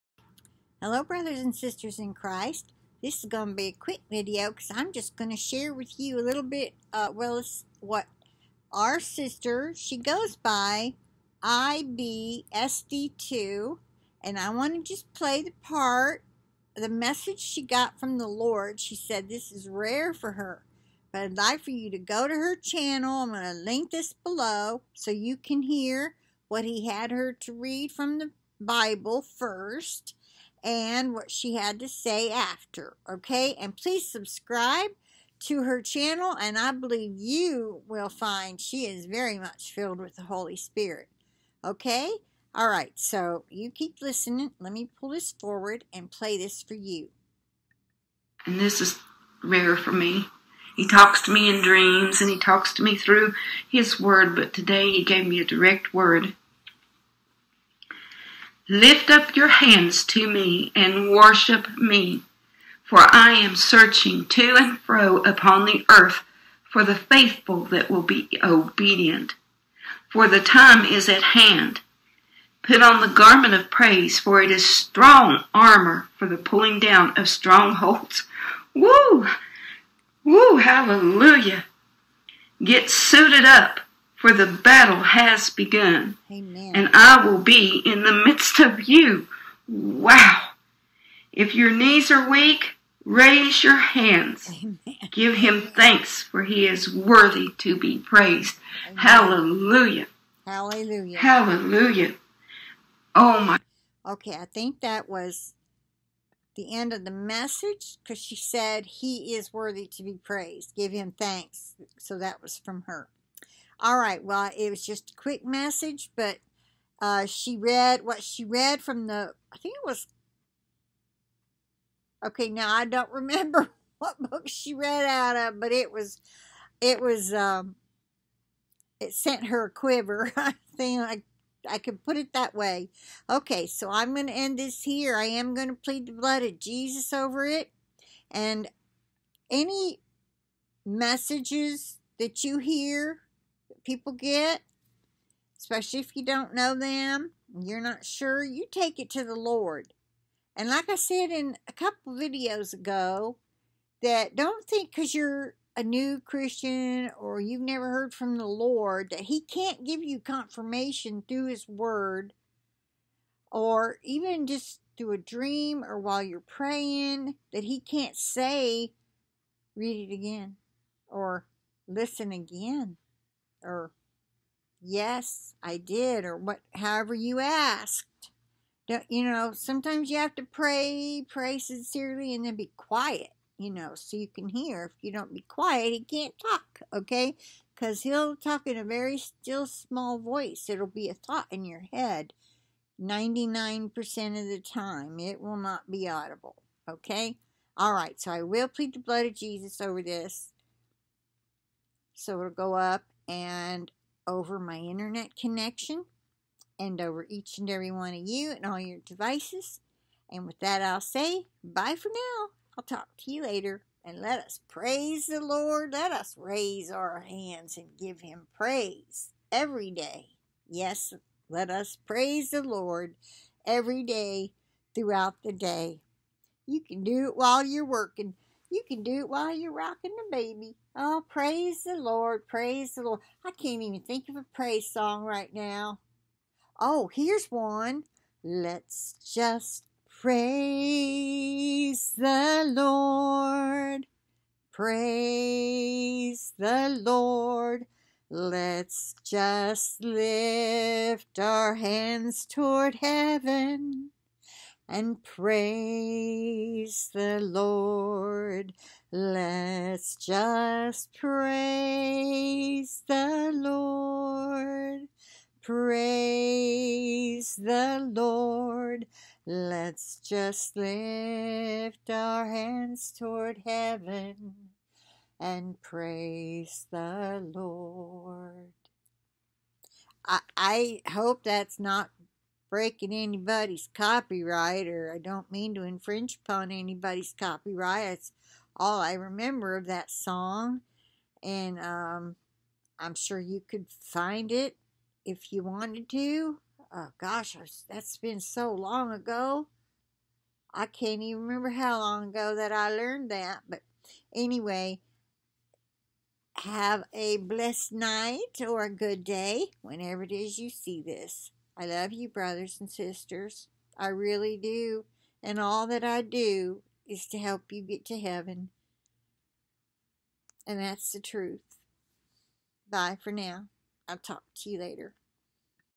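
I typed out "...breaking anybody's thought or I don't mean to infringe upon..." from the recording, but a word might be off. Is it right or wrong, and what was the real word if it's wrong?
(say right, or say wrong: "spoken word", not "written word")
wrong: "copyright", not "thought".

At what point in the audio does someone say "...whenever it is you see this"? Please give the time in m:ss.
5:09.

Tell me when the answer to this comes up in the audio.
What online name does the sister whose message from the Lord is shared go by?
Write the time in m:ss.
0:11.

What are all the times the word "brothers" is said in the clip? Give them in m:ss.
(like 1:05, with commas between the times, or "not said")
0:01, 5:12.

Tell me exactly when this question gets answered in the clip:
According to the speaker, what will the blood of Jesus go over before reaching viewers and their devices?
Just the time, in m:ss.
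3:24.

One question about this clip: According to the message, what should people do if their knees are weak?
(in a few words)
raise your hands.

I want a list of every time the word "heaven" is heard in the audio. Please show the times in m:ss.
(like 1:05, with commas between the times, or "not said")
4:12, 4:33, 5:18.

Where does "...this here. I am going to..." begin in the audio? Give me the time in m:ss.
2:14.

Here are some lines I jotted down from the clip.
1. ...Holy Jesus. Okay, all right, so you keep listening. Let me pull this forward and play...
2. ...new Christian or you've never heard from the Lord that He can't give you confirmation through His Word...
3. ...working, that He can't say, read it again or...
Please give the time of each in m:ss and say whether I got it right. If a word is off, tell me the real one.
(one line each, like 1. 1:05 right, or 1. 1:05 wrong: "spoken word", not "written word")
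1. 0:40 wrong: "Spirit", not "Jesus"
2. 2:35 right
3. 2:46 wrong: "praying", not "working".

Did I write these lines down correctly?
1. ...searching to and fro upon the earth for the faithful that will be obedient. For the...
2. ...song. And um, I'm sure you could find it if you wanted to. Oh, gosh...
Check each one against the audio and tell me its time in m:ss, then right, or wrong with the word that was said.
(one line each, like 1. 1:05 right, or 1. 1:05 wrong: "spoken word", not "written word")
1. 1:03 right
2. 4:50 right.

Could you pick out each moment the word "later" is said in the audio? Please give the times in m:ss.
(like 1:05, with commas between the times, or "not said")
3:33, 5:24.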